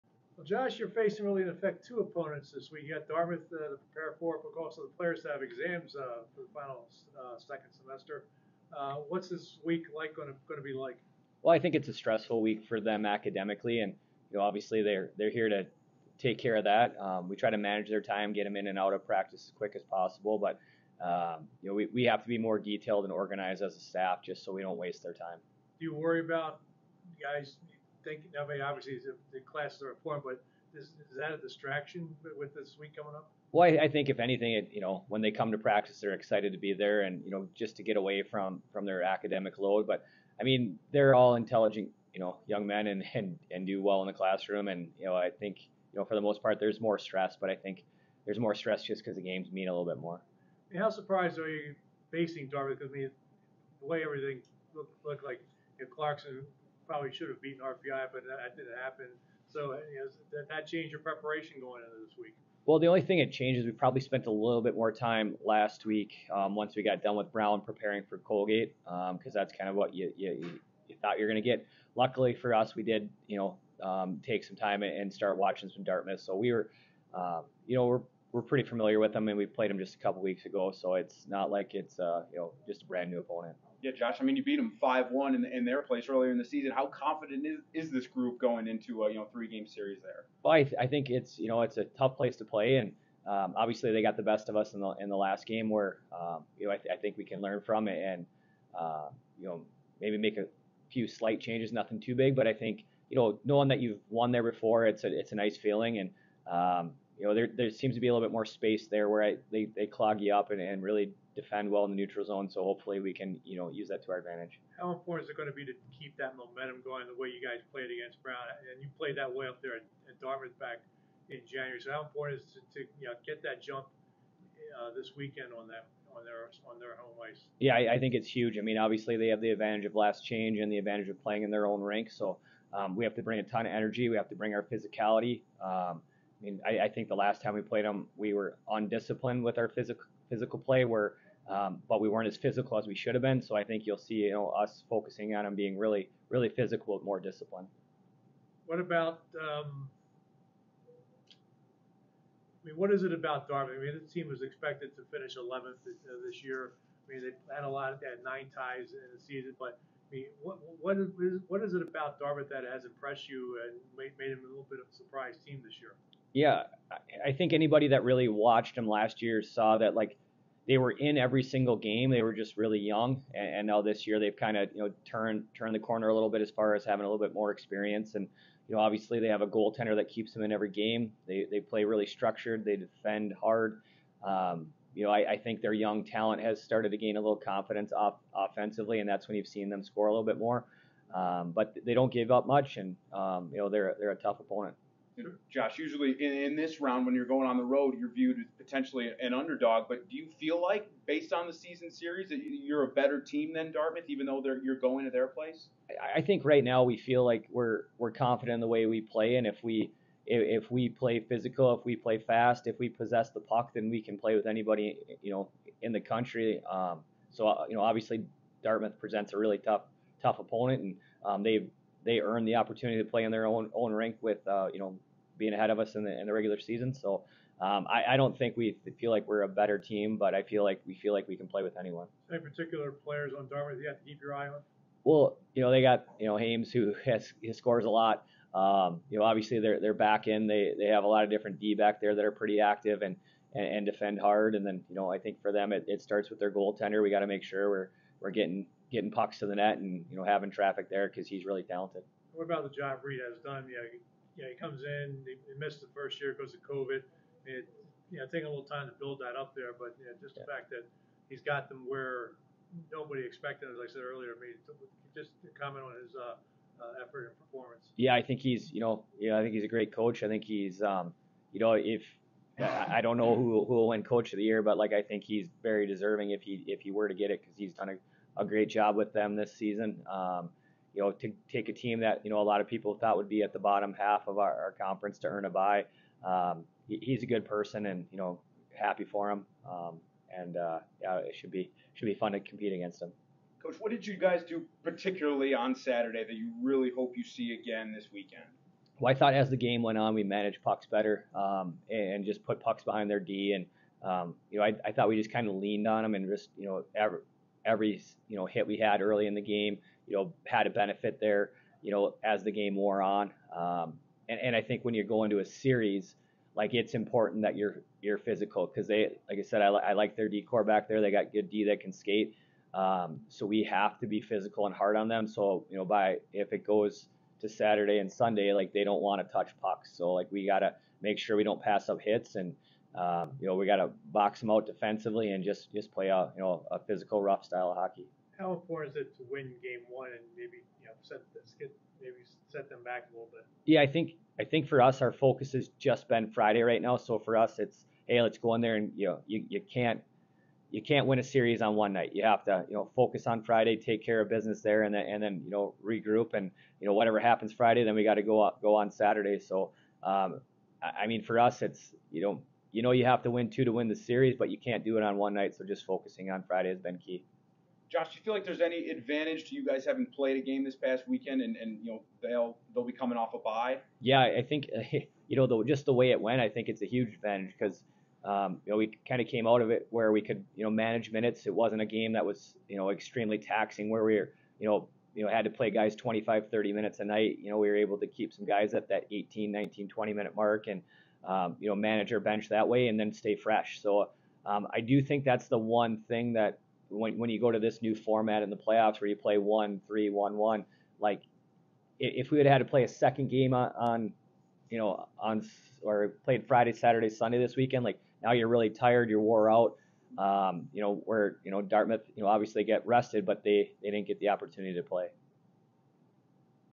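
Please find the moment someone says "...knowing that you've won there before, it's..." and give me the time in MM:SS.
01:43.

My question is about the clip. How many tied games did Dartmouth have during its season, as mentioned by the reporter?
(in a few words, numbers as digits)
9.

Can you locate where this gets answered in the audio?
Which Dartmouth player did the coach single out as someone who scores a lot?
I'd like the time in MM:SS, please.
03:56.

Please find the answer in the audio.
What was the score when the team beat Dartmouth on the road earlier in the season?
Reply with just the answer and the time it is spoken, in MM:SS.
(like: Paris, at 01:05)
5-1, at 01:24.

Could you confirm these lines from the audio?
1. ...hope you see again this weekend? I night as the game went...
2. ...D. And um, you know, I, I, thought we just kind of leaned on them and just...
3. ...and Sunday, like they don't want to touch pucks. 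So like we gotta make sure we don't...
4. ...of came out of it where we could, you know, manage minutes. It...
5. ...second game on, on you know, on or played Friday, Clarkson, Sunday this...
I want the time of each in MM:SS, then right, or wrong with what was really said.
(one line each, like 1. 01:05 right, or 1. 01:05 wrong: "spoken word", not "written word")
1. 04:56 wrong: "thought", not "night"
2. 05:03 right
3. 05:27 right
4. 06:19 right
5. 06:42 wrong: "Saturday", not "Clarkson".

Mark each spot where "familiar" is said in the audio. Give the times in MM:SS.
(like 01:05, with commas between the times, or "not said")
01:18.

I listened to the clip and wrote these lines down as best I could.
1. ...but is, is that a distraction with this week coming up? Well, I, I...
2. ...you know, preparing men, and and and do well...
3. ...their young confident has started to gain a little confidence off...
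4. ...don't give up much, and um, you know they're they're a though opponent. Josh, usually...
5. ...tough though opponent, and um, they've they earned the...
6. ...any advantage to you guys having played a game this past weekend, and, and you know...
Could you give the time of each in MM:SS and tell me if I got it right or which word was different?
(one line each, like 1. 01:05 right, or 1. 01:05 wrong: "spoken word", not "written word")
1. 00:30 right
2. 00:42 wrong: "young", not "preparing"
3. 03:05 wrong: "talent", not "confident"
4. 03:11 wrong: "tough", not "though"
5. 03:39 wrong: "tough", not "though"
6. 06:08 right.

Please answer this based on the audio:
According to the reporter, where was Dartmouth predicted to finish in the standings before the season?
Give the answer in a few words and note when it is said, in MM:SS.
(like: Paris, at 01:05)
11th, at 02:35.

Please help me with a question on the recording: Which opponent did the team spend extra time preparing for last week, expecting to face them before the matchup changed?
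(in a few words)
Colgate.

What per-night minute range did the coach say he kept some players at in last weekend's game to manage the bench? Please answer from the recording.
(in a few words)
18 to 20 minutes.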